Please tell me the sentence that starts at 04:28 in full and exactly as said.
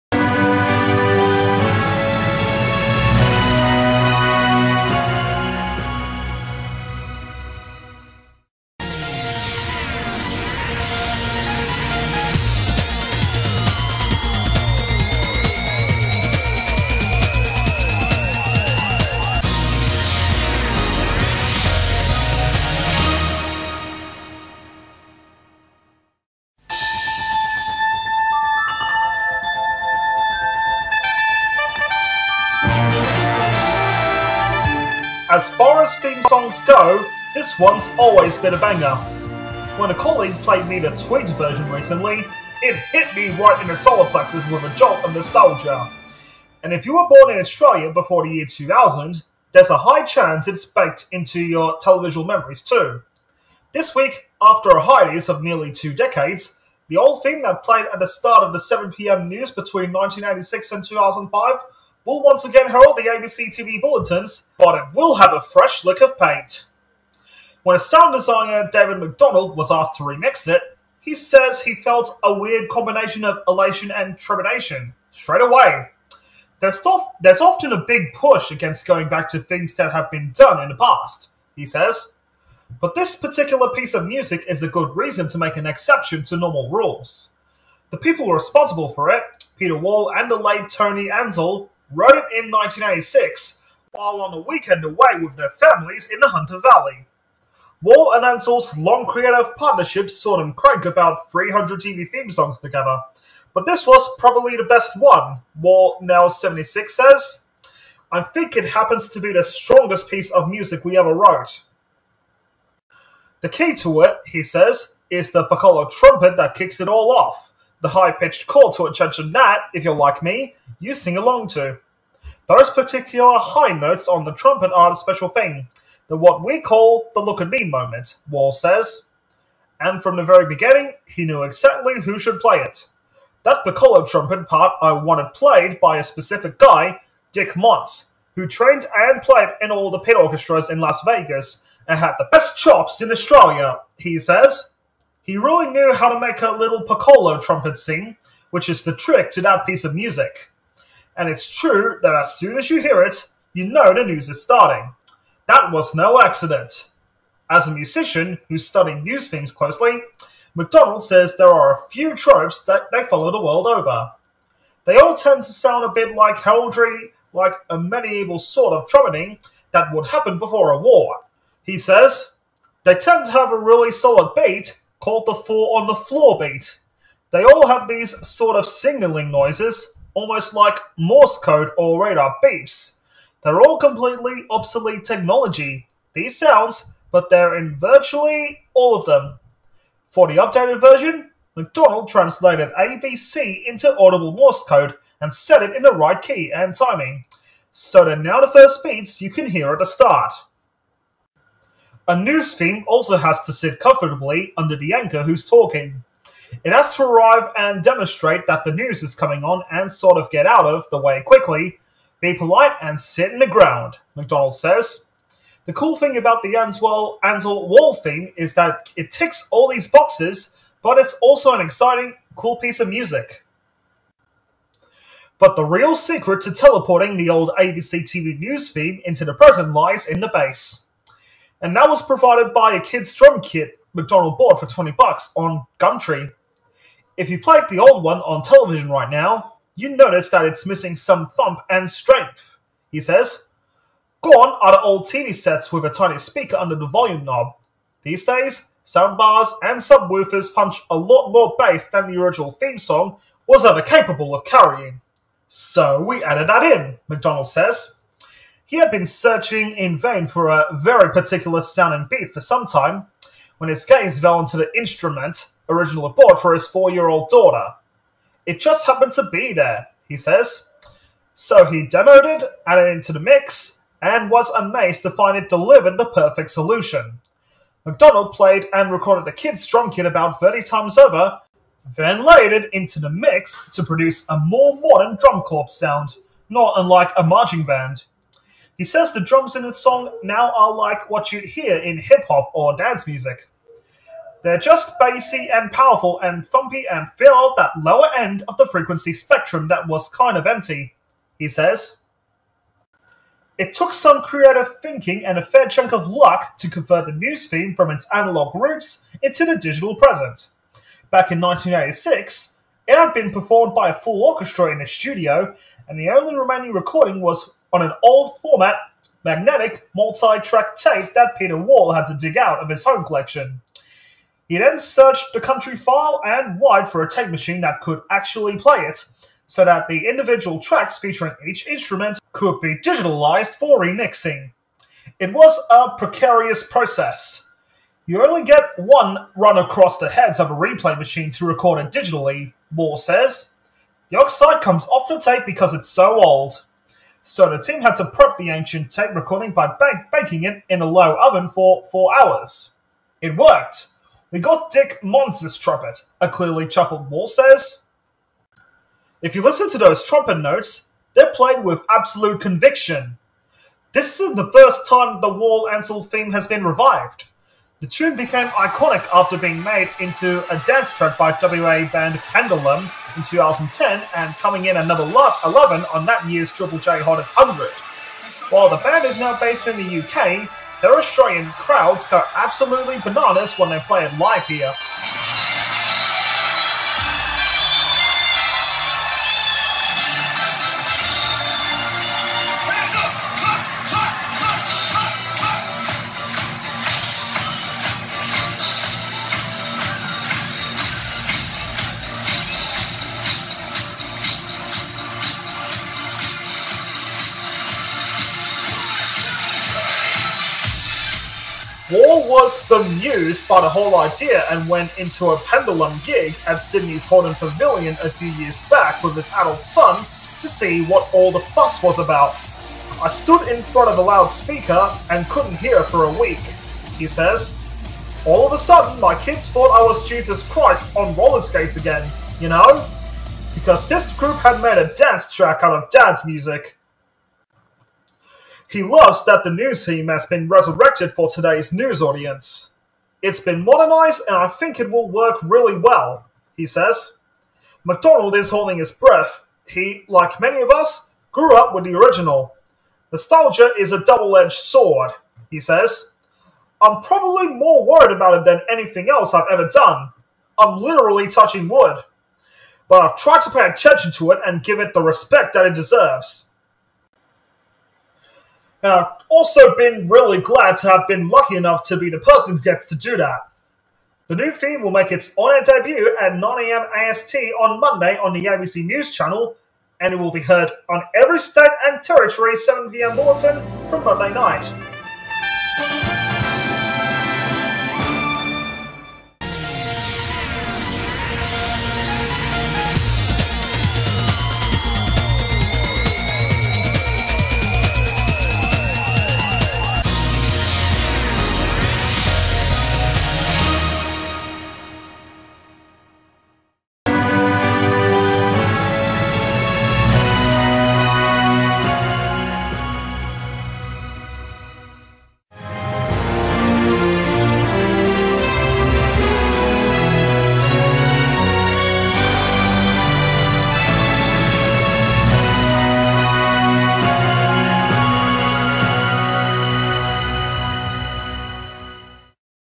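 It just happened to be there, he says.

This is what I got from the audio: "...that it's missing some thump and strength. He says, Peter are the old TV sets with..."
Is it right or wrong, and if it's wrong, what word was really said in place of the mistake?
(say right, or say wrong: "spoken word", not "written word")
wrong: "Gone", not "Peter".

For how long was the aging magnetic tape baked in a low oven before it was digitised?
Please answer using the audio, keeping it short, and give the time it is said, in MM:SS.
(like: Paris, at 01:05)
4 hours, at 05:51.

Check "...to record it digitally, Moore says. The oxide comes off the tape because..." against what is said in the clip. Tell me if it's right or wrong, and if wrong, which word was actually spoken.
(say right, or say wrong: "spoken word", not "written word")
right.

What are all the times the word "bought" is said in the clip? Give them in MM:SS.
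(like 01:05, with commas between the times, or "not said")
03:54, 04:26.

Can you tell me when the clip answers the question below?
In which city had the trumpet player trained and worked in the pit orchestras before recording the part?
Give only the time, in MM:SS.
02:20.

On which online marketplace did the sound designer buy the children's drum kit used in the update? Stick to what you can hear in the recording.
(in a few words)
Gumtree.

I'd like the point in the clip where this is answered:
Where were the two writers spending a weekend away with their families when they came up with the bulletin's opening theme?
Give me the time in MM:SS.
01:36.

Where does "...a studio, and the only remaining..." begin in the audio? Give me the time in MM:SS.
05:14.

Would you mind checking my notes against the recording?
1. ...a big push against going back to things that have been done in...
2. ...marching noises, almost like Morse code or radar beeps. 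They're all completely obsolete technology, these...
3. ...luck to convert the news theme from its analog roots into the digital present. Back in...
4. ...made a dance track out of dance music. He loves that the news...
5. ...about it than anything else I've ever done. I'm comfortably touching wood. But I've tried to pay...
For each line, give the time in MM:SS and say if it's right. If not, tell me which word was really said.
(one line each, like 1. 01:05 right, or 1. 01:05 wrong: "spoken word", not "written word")
1. 01:17 right
2. 02:58 wrong: "signaling", not "marching"
3. 05:06 right
4. 07:14 right
5. 07:38 wrong: "literally", not "comfortably".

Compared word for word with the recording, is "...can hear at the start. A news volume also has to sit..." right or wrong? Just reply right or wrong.
wrong.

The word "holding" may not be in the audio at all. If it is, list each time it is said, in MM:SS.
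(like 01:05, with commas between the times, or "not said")
07:28.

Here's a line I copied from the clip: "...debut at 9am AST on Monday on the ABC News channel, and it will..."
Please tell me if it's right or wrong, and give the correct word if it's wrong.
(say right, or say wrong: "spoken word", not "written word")
right.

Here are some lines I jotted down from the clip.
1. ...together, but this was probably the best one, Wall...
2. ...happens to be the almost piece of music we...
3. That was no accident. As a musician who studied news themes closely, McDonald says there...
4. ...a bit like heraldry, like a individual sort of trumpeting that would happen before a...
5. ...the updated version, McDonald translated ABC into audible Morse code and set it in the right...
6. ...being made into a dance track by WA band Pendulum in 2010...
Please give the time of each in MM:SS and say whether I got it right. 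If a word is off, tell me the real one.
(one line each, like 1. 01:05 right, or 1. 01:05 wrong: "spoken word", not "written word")
1. 01:42 right
2. 01:48 wrong: "strongest", not "almost"
3. 02:35 right
4. 02:45 wrong: "medieval", not "individual"
5. 03:10 right
6. 06:09 right.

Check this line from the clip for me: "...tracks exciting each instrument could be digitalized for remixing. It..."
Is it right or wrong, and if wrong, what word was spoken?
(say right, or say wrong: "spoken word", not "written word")
wrong: "featuring", not "exciting".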